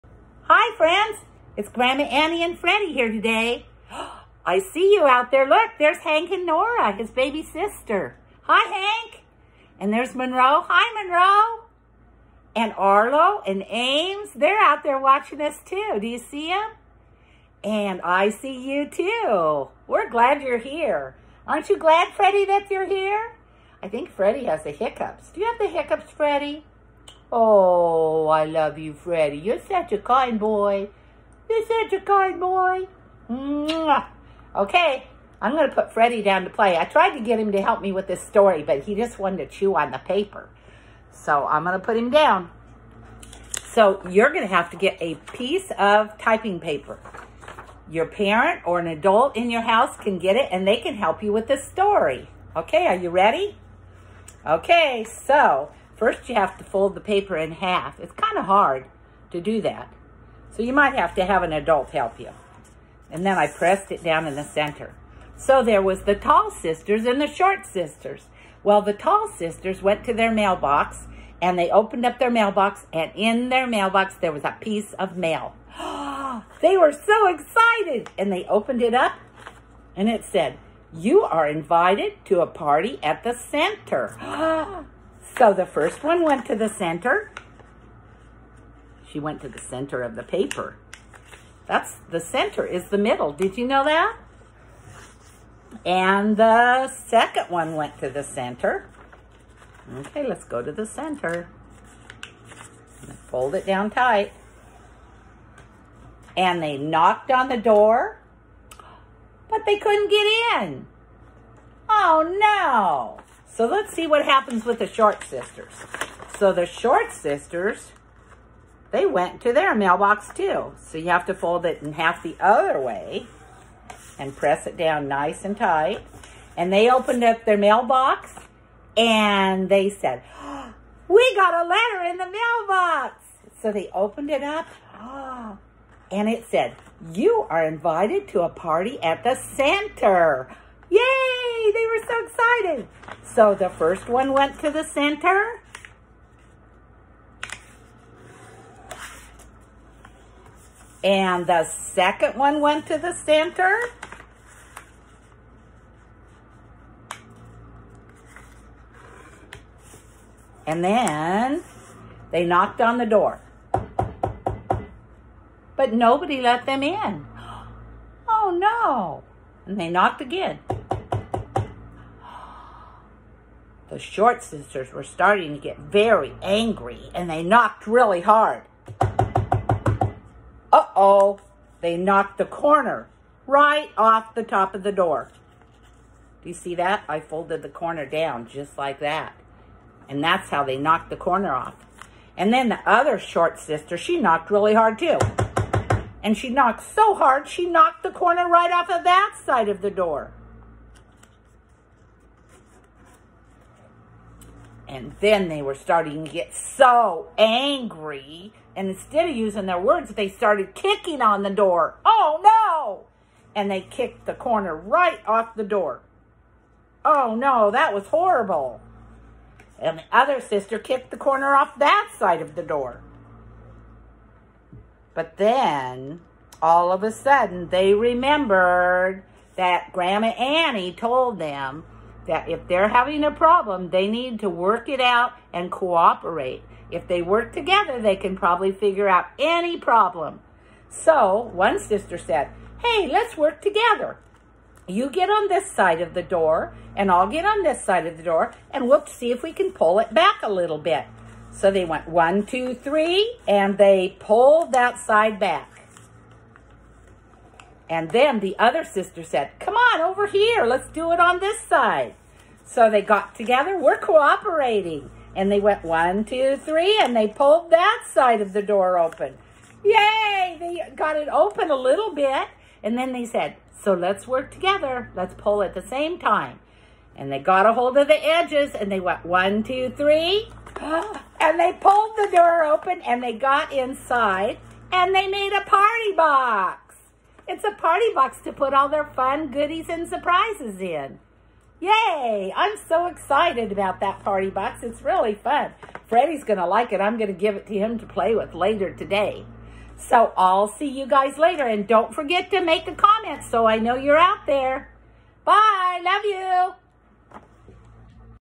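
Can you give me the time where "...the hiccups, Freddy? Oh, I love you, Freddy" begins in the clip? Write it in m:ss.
0:25.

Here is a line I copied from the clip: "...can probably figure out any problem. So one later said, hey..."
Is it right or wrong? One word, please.
wrong.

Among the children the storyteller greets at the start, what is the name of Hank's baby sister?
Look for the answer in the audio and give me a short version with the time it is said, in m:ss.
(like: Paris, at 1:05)
Nora, at 0:06.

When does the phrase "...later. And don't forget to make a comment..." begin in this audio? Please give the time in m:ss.
5:01.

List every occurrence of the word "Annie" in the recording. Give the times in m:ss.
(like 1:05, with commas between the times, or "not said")
0:02, 3:50.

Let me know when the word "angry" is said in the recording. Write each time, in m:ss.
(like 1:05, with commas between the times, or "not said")
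2:56, 3:27.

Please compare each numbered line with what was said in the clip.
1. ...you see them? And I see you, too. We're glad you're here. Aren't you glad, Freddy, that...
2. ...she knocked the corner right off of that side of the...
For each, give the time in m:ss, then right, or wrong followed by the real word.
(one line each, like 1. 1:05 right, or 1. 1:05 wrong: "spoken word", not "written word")
1. 0:16 right
2. 3:17 right.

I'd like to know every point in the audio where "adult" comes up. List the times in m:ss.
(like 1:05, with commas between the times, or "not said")
0:48, 1:01.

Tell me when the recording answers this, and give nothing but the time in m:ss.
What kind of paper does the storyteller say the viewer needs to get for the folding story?
0:46.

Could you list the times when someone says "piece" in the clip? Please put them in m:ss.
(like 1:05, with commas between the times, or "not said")
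0:45, 1:14.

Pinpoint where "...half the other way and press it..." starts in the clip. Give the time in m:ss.
2:01.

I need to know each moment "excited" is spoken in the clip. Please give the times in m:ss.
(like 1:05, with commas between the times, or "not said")
1:17, 2:22, 4:53.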